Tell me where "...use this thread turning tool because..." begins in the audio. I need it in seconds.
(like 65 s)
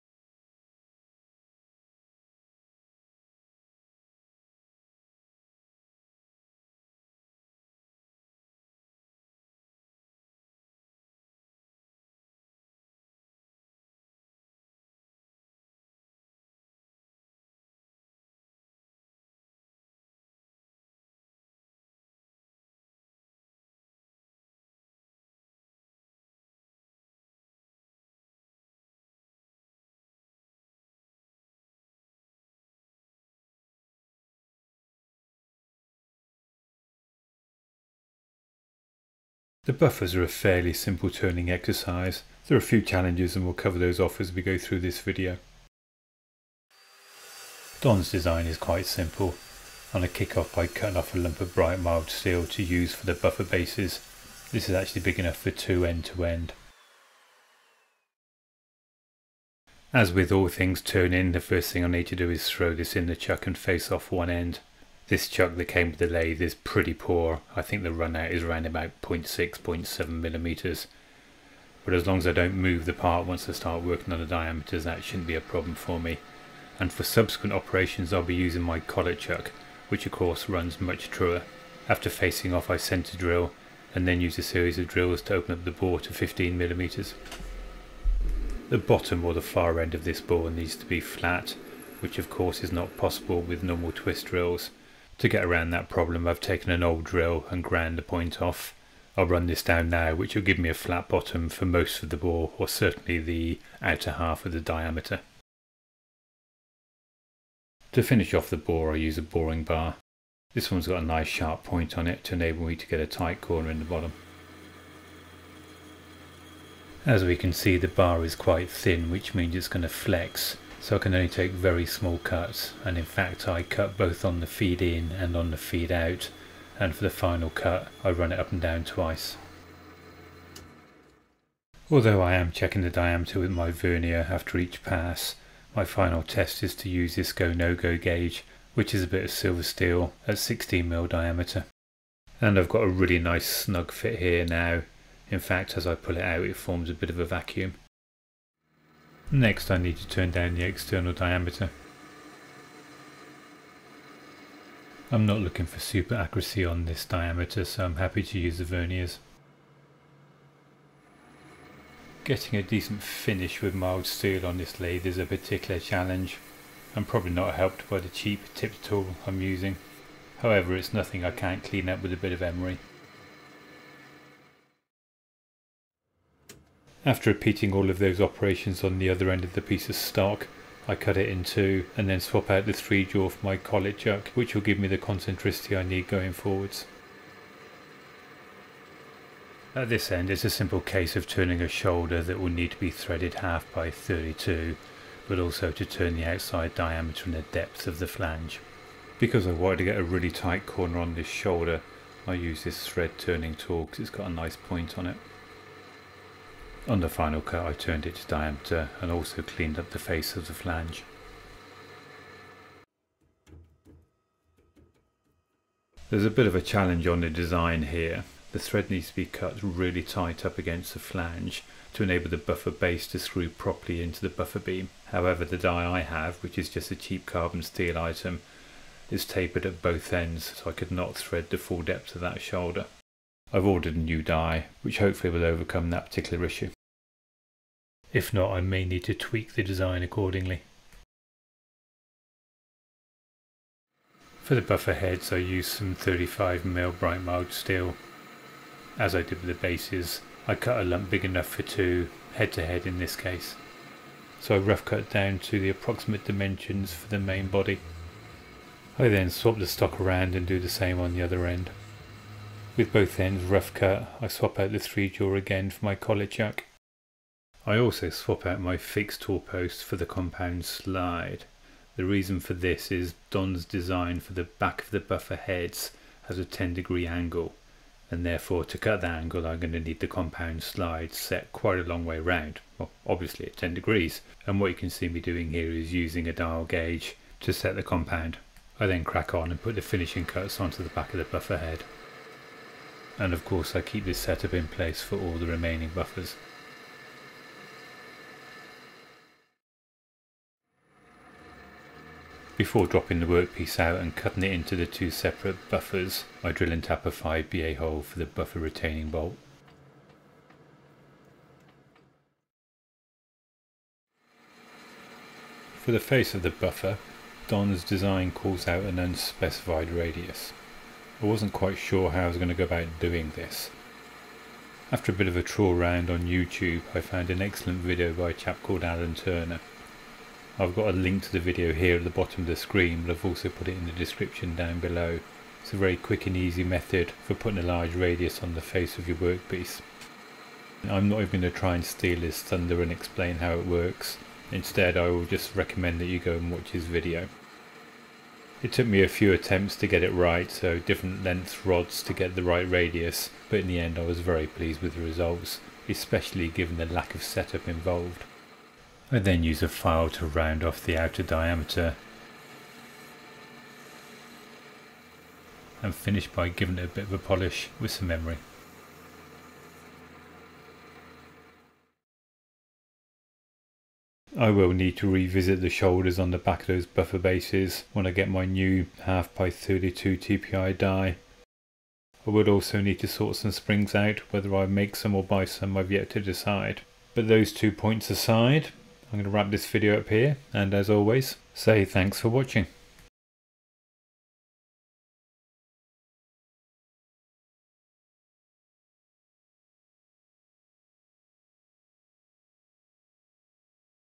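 202 s.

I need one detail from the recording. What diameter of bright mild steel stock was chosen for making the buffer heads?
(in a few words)
35mm.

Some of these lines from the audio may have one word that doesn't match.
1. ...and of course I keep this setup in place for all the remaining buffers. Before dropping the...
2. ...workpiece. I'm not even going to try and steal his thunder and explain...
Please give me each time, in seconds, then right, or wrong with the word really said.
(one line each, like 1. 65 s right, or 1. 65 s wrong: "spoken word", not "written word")
1. 293 s right
2. 339 s right.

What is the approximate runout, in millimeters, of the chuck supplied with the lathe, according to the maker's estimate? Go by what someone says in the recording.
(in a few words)
0.6 to 0.7 mm.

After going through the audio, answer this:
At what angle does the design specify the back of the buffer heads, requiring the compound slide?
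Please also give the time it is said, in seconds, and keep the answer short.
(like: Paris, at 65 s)
10 degrees, at 276 s.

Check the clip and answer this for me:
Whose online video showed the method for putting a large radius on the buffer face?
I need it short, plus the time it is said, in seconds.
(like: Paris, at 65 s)
Alan Turner, at 328 s.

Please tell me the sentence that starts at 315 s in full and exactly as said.
For the face of the buffer, Don's design calls out an unspecified radius.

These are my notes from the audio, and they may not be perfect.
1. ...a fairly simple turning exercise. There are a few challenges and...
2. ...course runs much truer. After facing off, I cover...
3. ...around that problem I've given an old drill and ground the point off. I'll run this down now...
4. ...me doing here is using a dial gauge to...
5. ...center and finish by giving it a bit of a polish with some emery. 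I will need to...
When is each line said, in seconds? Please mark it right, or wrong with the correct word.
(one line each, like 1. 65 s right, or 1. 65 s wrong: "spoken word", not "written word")
1. 40 s right
2. 80 s wrong: "center", not "cover"
3. 95 s wrong: "taken", not "given"
4. 285 s right
5. 361 s wrong: "diameter", not "center".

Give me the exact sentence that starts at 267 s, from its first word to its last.
I also swap out my fixed tool post for the compound slide.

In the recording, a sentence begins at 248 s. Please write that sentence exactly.
As I did with the bases, I cut a lump big enough for two, head to head in this case.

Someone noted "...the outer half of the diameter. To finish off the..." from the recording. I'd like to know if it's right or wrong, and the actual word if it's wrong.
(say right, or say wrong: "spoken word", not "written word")
right.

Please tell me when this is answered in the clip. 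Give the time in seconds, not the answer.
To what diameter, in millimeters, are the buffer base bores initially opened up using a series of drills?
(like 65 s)
86 s.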